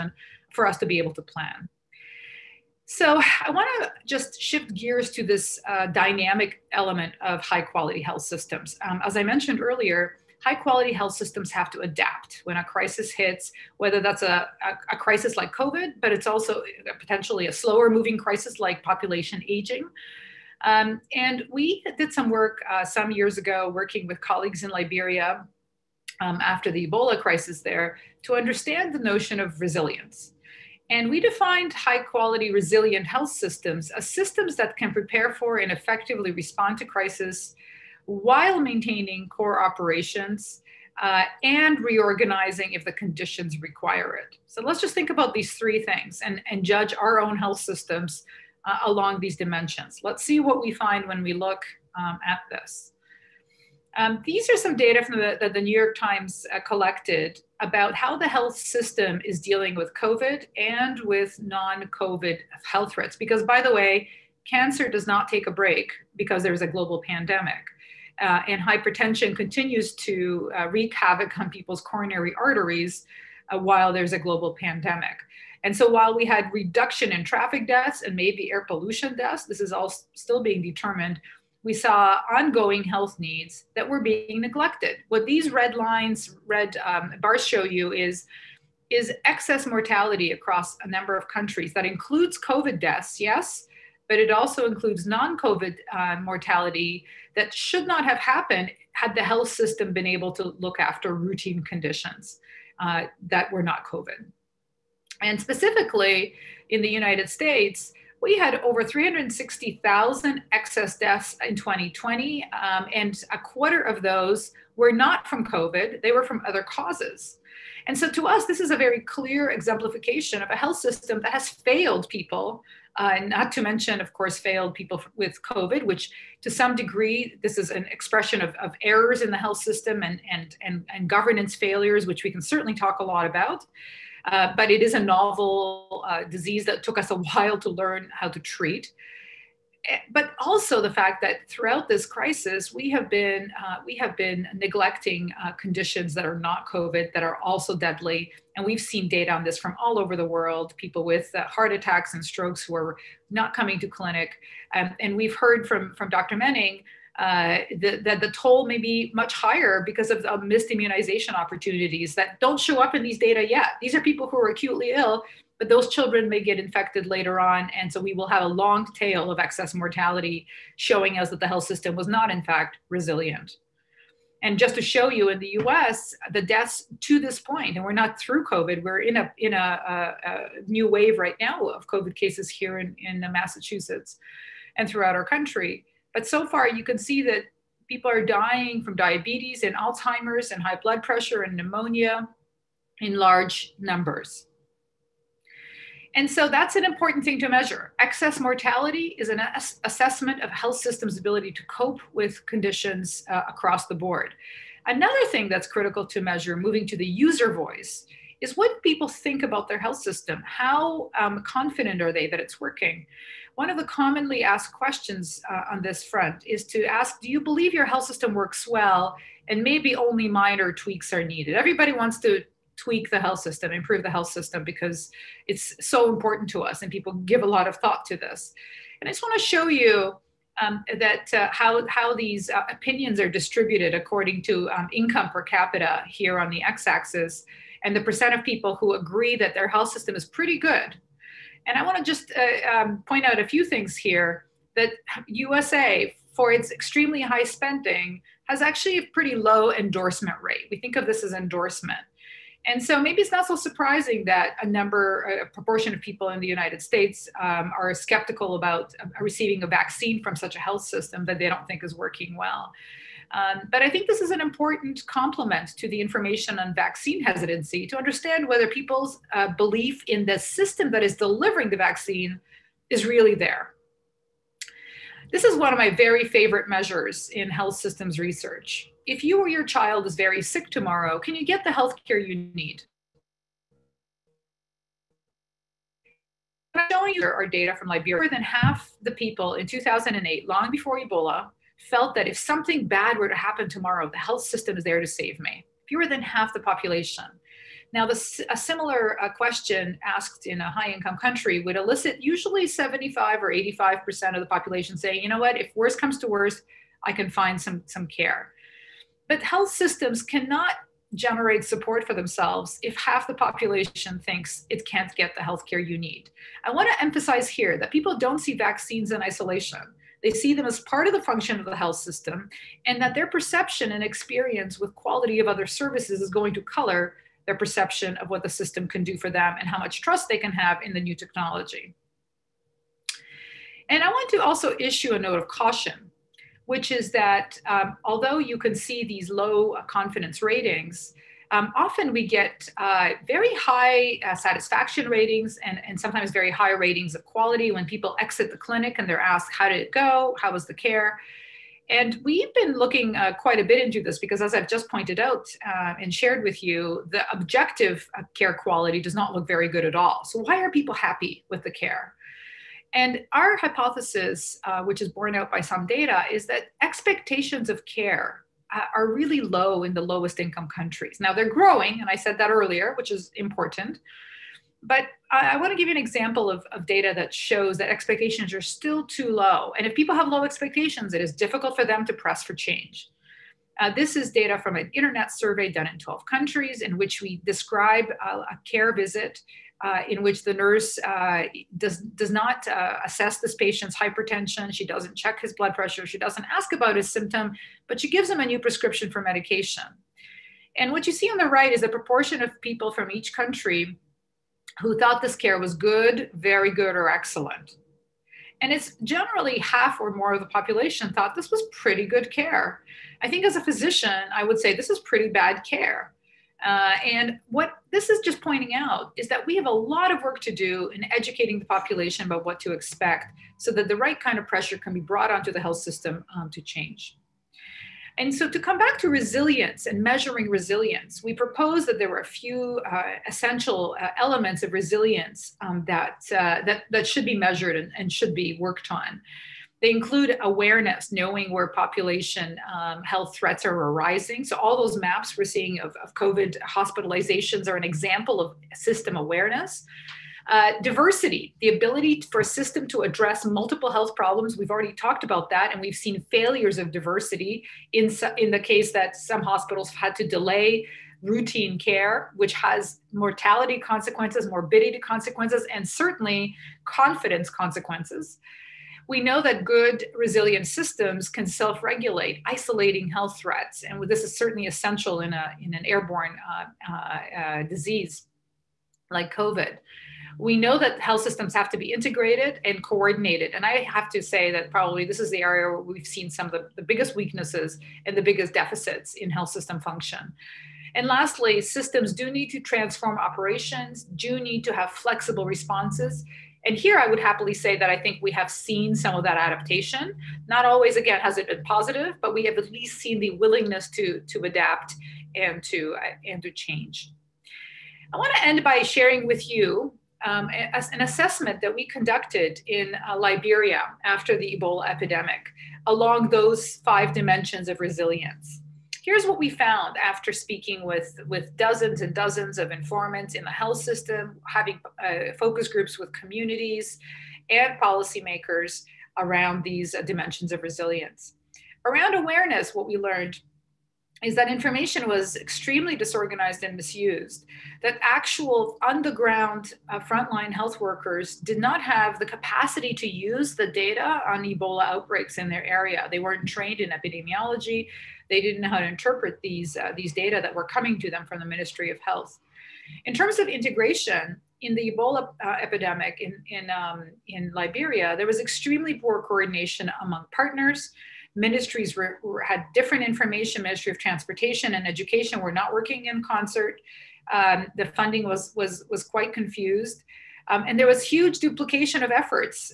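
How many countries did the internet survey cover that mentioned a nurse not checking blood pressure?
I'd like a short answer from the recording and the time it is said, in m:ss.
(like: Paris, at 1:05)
12, at 6:25.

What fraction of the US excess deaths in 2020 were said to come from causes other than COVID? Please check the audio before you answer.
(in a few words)
A quarter.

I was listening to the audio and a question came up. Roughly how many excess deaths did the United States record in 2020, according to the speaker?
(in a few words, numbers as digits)
360,000.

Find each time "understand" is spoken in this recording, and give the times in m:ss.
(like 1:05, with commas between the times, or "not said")
0:28, 4:27.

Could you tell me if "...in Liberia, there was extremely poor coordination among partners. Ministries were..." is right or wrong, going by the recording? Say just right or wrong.
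right.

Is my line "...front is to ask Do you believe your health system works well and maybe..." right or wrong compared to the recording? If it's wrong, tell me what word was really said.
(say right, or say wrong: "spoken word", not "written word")
right.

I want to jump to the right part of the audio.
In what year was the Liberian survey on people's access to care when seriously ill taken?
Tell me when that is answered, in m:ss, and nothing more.
4:49.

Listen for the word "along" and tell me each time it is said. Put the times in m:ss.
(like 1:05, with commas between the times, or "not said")
0:48, 8:35.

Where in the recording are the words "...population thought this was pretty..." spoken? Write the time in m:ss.
6:50.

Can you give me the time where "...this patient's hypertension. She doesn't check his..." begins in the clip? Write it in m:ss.
6:33.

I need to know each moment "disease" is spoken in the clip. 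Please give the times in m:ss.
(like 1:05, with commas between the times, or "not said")
2:16, 7:57.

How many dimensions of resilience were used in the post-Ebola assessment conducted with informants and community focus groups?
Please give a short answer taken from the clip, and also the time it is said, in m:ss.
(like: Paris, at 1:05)
5, at 8:36.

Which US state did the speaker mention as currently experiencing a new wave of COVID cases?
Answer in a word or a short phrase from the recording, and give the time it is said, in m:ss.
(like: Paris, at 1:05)
Massachusetts, at 3:03.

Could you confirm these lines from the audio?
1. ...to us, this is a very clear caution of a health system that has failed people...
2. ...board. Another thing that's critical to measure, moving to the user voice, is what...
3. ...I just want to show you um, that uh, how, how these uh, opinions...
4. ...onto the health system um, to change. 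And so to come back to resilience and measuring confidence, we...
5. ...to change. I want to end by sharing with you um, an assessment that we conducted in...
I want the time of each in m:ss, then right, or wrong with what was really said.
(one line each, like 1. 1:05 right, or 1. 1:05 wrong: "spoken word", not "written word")
1. 1:58 wrong: "exemplification", not "caution"
2. 3:23 right
3. 3:49 right
4. 7:05 wrong: "resilience", not "confidence"
5. 8:26 right.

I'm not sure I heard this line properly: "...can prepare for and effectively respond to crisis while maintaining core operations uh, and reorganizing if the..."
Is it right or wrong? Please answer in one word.
right.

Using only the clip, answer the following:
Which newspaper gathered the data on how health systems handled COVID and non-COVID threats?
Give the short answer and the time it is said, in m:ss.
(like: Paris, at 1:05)
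The New York Times, at 0:55.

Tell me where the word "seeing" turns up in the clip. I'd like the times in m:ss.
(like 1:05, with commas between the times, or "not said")
7:25.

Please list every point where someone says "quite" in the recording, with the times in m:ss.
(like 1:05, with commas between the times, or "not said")
5:53, 9:29.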